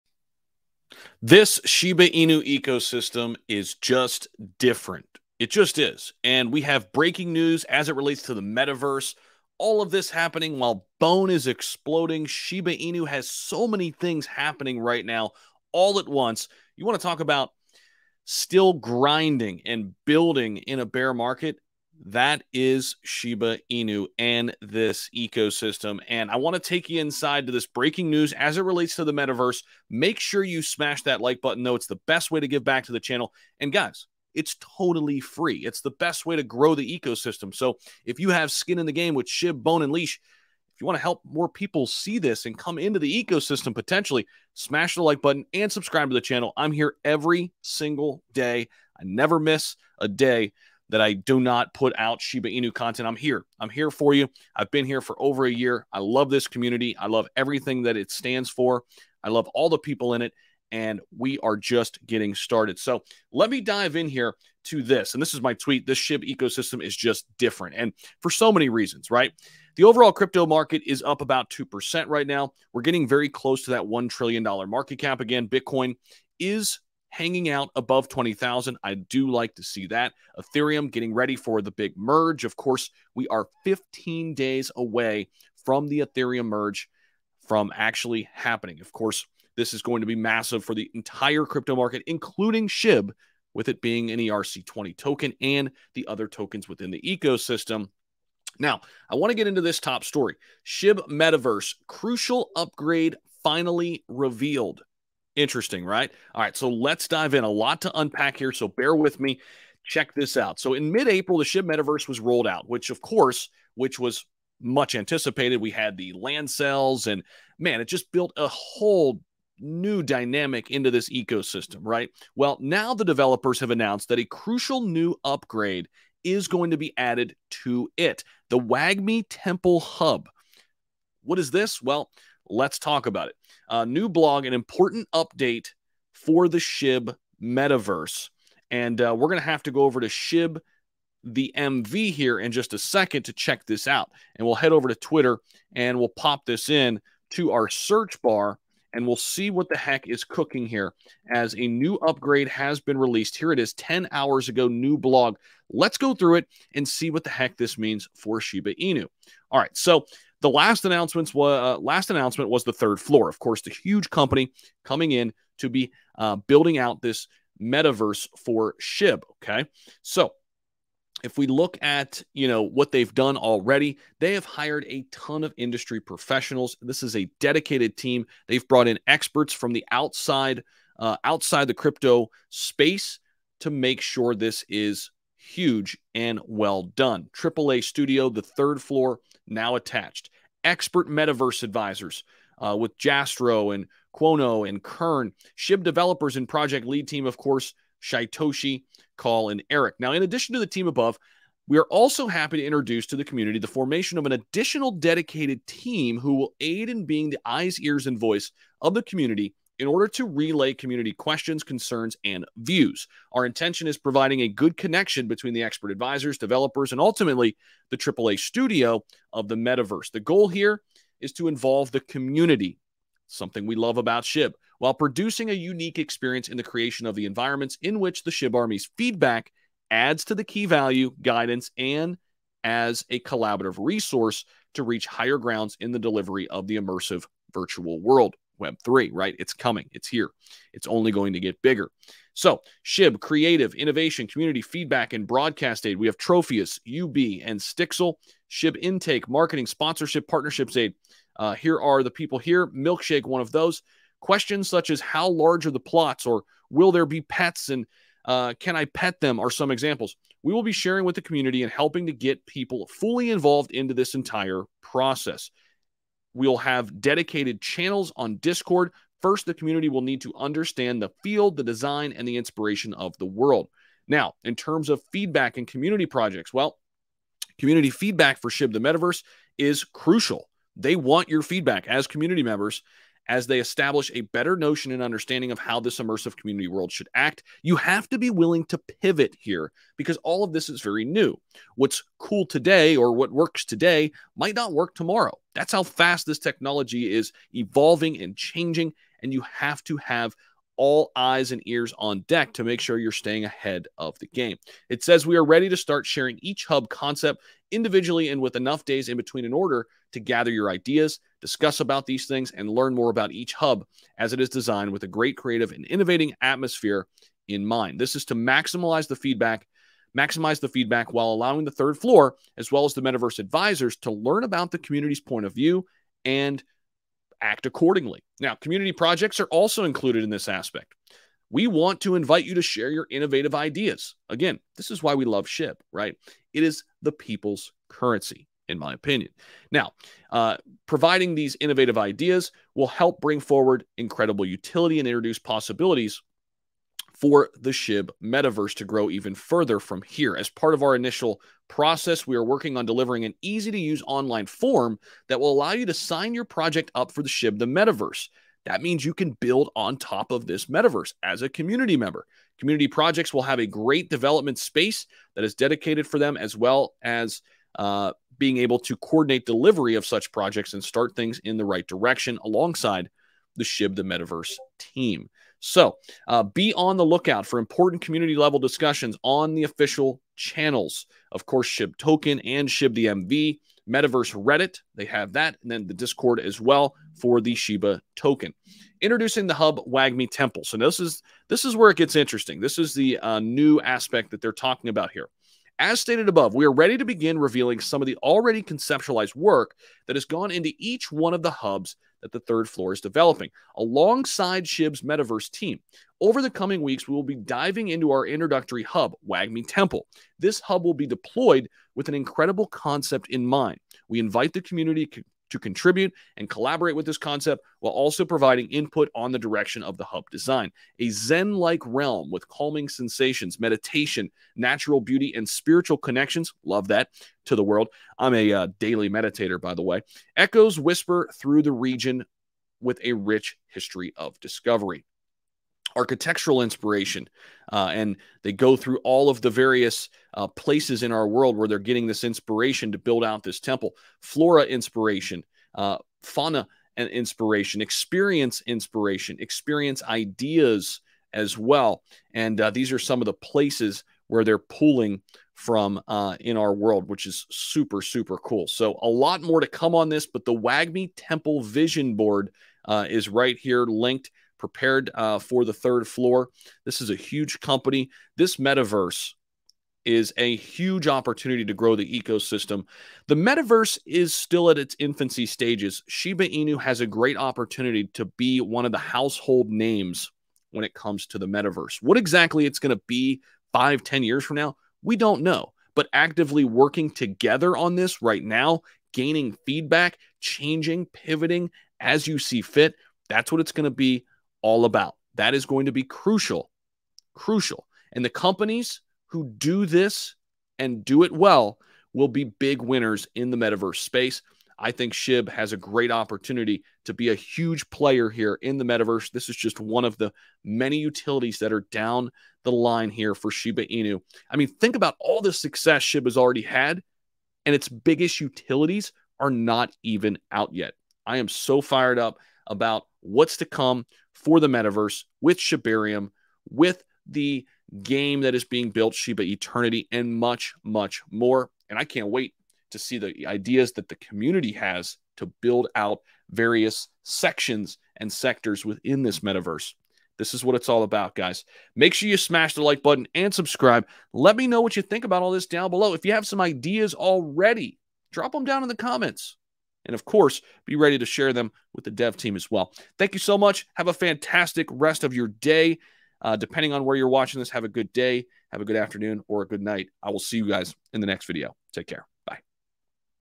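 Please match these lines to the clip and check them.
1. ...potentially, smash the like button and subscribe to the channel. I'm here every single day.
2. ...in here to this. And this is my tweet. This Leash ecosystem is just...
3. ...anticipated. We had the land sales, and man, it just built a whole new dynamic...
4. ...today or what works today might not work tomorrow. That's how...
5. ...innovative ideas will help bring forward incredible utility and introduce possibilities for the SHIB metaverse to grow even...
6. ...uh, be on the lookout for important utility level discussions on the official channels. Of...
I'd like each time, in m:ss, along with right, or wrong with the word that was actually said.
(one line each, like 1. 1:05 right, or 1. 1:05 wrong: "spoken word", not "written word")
1. 0:43 right
2. 1:03 wrong: "SHIB", not "Leash"
3. 1:54 right
4. 4:52 right
5. 5:41 right
6. 6:16 wrong: "community", not "utility".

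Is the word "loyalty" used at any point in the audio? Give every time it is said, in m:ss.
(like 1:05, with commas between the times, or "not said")
not said.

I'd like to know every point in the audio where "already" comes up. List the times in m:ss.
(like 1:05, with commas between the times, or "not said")
2:53, 6:38, 8:36, 9:07.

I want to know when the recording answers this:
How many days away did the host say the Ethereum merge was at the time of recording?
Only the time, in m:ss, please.
1:23.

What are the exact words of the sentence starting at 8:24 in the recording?
I think Shib has a great opportunity to be a huge player here in the metaverse.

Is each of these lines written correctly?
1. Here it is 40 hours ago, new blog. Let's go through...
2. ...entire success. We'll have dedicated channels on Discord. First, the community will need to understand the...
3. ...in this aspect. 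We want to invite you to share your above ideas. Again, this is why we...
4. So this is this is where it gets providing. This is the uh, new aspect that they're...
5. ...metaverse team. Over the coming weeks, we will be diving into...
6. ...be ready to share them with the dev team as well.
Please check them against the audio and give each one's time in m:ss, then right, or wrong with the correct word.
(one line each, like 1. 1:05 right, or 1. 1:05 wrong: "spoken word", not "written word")
1. 2:33 wrong: "10", not "40"
2. 4:24 wrong: "process", not "success"
3. 5:30 wrong: "innovative", not "above"
4. 6:30 wrong: "interesting", not "providing"
5. 6:45 right
6. 9:10 right.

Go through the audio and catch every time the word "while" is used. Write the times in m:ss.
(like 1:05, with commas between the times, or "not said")
0:10, 3:44, 5:21, 6:57.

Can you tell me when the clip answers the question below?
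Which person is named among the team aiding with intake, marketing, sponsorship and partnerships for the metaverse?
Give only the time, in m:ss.
4:12.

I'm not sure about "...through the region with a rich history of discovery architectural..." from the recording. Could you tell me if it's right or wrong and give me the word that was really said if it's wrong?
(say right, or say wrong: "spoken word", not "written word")
right.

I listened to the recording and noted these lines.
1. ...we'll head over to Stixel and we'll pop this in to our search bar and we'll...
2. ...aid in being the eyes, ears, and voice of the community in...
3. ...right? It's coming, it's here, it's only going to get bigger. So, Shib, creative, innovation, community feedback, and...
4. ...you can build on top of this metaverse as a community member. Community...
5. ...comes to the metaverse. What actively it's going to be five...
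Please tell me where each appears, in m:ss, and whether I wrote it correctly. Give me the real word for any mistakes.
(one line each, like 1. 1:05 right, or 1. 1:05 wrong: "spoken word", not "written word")
1. 2:24 wrong: "Twitter", not "Stixel"
2. 3:26 right
3. 3:59 right
4. 5:59 right
5. 8:00 wrong: "exactly", not "actively".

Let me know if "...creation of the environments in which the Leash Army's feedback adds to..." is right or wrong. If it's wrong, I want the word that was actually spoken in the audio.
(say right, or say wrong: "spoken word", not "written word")
wrong: "SHIB", not "Leash".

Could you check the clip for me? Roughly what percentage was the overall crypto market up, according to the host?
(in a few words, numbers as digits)
2%.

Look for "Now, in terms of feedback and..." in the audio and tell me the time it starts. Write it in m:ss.
4:34.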